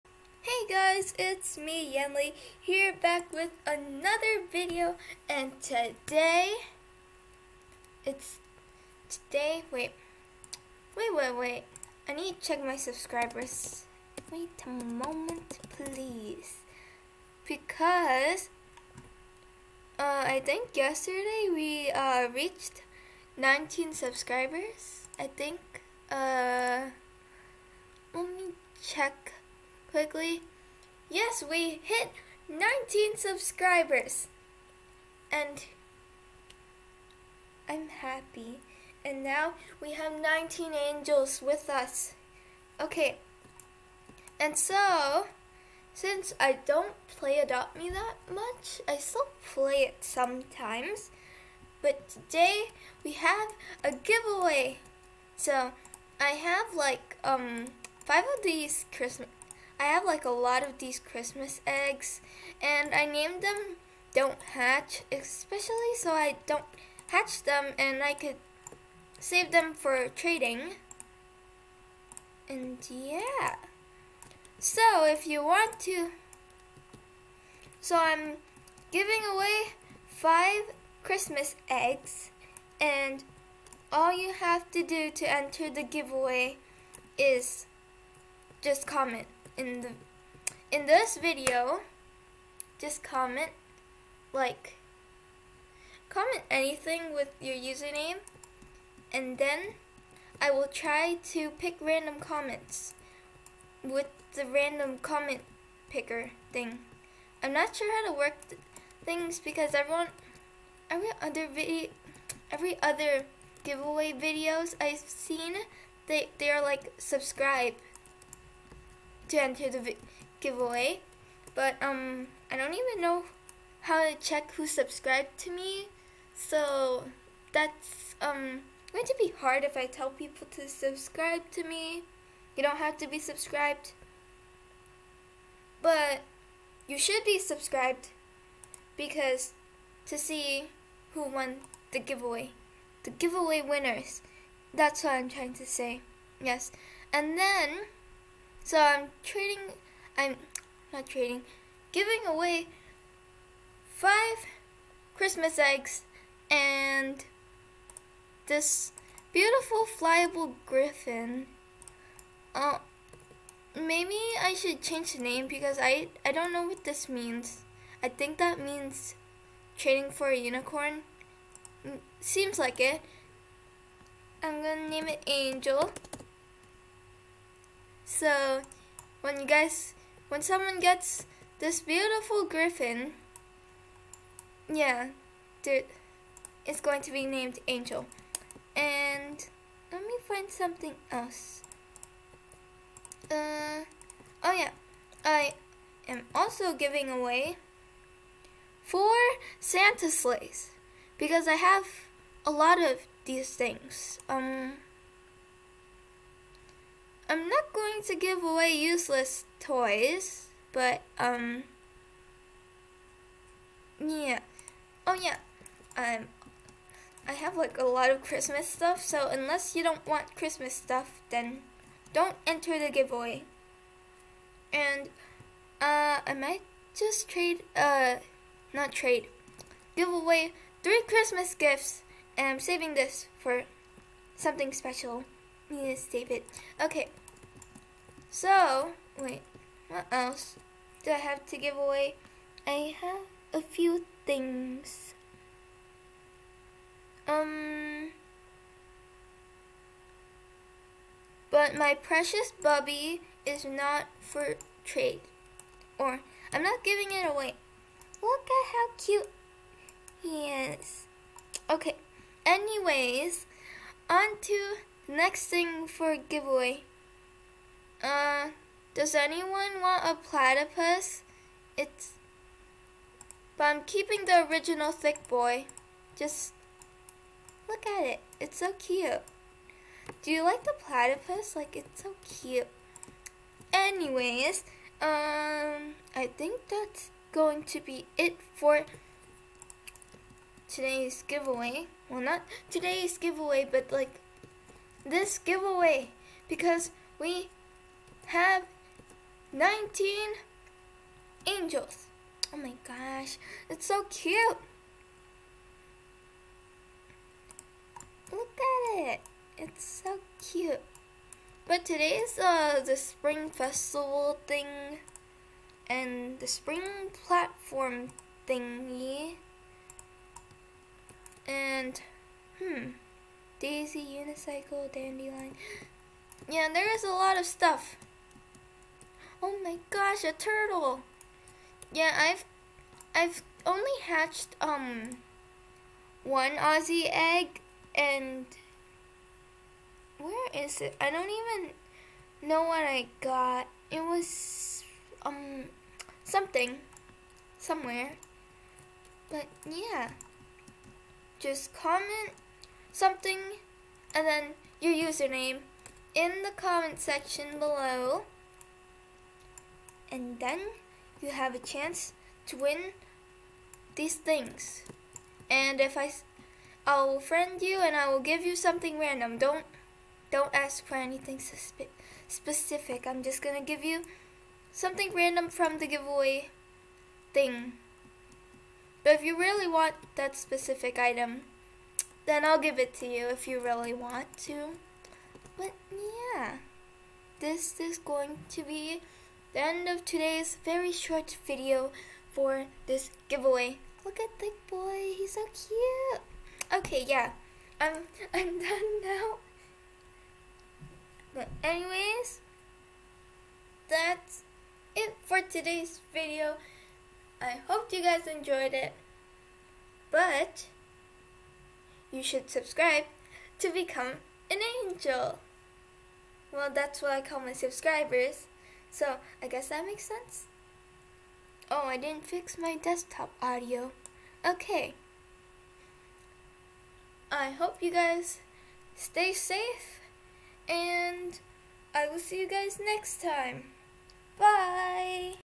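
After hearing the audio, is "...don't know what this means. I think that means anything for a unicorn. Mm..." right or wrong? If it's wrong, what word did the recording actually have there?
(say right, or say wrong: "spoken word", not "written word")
wrong: "trading", not "anything".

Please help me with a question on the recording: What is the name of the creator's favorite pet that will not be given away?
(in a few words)
Bubby.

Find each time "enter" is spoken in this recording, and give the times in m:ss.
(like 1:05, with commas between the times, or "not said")
1:25, 1:59, 3:42.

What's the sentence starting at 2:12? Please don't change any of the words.
You don't have to be subscribed.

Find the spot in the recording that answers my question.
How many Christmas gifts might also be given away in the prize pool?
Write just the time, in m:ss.
3:50.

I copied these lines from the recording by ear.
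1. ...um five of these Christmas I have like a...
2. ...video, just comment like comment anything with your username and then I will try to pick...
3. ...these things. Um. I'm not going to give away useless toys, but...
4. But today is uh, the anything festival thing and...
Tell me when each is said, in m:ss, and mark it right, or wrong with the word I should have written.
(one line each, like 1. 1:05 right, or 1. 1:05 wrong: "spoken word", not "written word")
1. 0:57 right
2. 1:31 right
3. 3:23 right
4. 5:11 wrong: "spring", not "anything".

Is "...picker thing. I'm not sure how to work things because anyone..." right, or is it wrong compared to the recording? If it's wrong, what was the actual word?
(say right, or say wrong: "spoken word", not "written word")
wrong: "everyone", not "anyone".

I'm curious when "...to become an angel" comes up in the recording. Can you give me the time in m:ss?
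6:53.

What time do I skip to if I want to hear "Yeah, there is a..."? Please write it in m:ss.
5:26.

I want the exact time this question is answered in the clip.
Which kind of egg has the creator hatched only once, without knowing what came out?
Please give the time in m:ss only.
5:36.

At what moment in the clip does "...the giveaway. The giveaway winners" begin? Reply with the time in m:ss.
2:21.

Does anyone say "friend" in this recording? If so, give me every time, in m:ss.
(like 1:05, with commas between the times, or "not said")
6:07.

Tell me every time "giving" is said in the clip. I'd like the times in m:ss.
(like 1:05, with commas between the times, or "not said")
1:18, 2:31, 3:16, 4:16.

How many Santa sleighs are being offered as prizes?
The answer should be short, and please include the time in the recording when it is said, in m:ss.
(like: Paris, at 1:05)
4, at 3:18.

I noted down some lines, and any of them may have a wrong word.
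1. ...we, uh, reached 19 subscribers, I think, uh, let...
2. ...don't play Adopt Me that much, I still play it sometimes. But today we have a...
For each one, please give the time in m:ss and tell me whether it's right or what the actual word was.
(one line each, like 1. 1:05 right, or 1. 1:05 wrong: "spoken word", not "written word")
1. 0:21 right
2. 0:46 right.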